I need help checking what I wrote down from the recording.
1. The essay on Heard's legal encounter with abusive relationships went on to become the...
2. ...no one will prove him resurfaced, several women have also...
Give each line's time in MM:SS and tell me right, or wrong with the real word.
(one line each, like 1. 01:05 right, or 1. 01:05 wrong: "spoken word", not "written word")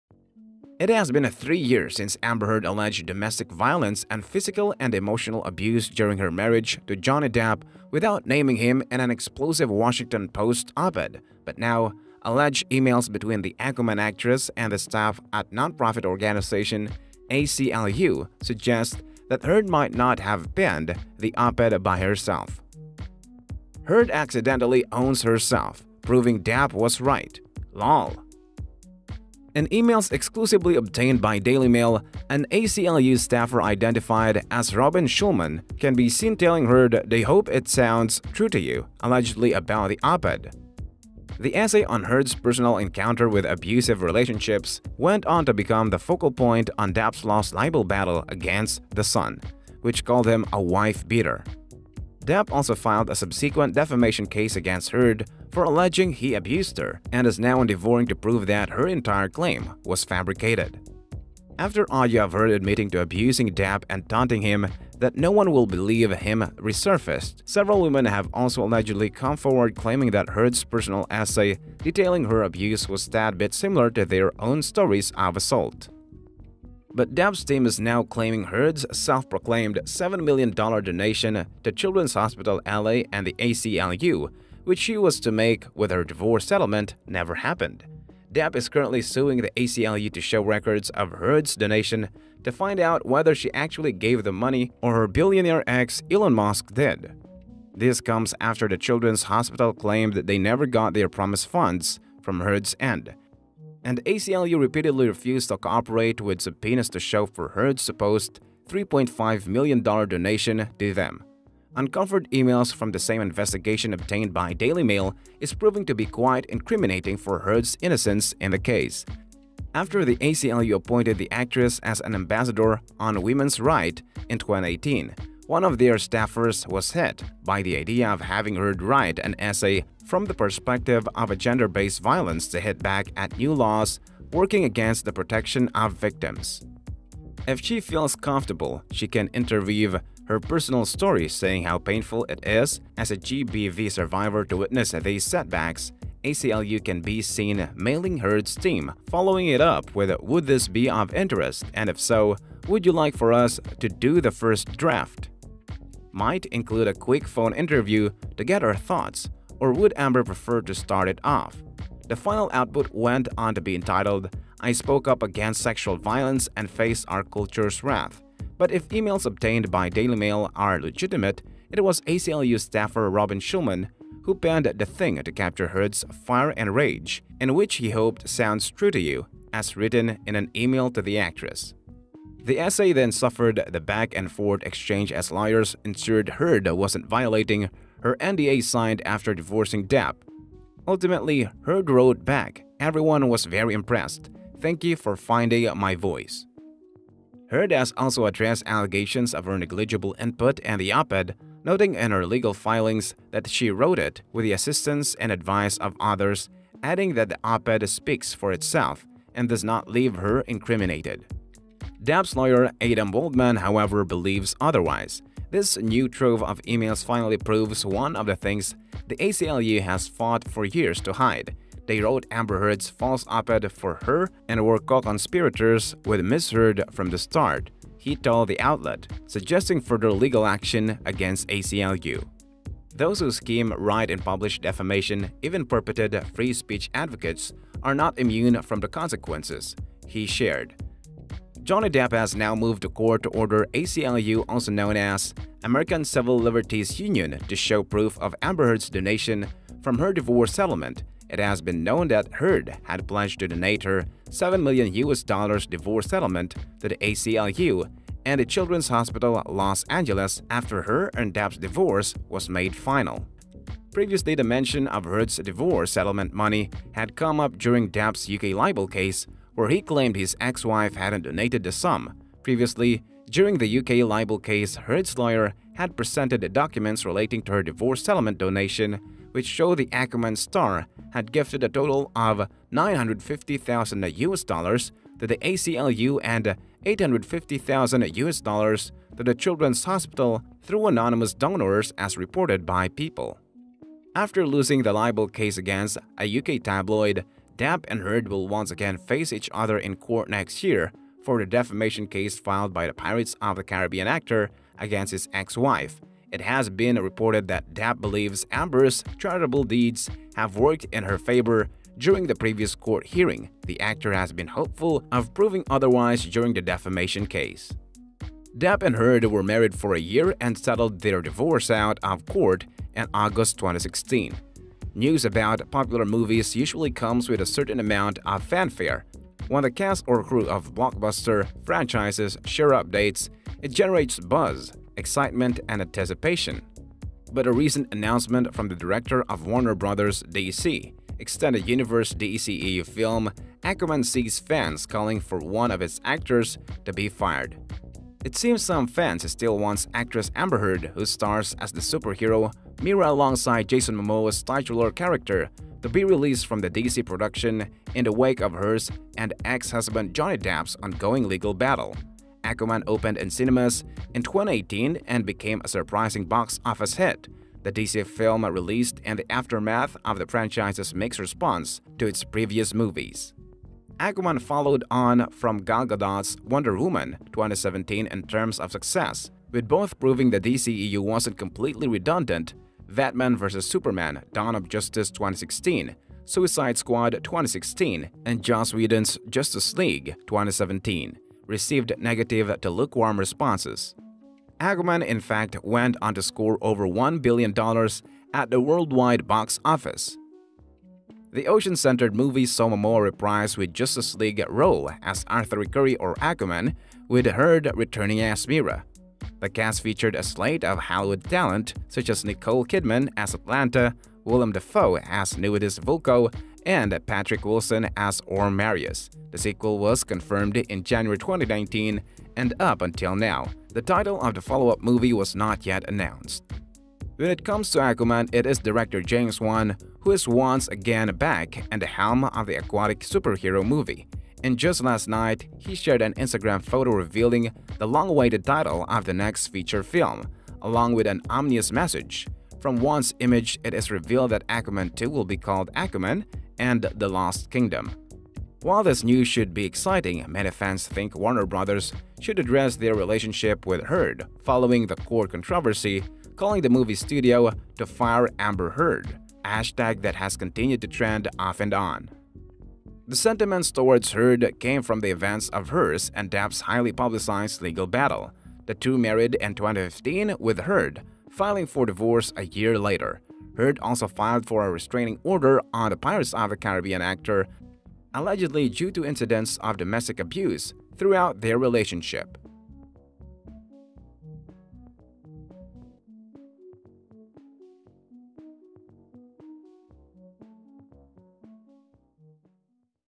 1. 00:41 wrong: "personal", not "legal"
2. 01:05 wrong: "believe", not "prove".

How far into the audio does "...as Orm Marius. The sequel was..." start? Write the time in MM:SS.
06:57.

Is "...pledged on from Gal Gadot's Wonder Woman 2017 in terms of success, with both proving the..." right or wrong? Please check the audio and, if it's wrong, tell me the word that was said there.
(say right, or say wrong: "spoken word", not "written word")
wrong: "followed", not "pledged".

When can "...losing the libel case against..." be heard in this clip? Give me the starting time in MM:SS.
04:54.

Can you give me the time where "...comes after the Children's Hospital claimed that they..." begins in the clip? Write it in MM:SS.
01:38.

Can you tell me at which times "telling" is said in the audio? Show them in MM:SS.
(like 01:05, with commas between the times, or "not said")
00:36.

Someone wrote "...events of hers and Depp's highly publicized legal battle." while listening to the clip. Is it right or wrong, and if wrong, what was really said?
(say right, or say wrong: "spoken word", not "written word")
right.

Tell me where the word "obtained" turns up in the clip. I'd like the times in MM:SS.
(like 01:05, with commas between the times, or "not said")
00:30, 01:53, 02:49.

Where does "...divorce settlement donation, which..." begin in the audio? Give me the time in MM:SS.
04:37.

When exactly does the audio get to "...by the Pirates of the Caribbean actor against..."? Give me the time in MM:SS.
05:02.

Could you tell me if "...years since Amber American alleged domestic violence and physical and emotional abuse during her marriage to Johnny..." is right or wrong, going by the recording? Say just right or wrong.
wrong.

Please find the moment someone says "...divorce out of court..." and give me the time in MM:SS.
05:21.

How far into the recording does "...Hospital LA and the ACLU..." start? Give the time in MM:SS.
01:22.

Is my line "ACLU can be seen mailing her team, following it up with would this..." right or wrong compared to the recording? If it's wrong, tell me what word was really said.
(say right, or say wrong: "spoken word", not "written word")
right.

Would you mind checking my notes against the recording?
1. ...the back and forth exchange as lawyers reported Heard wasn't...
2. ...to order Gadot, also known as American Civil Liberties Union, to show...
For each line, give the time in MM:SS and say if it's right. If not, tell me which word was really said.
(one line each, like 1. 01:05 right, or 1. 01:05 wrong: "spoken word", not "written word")
1. 03:03 wrong: "ensured", not "reported"
2. 04:03 wrong: "ACLU", not "Gadot".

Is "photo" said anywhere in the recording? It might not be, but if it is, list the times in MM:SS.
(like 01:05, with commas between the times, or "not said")
07:16.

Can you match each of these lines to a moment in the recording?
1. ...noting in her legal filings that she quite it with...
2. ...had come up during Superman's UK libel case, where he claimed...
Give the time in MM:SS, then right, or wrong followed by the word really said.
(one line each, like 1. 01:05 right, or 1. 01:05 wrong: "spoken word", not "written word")
1. 03:21 wrong: "wrote", not "quite"
2. 04:26 wrong: "Depp", not "Superman".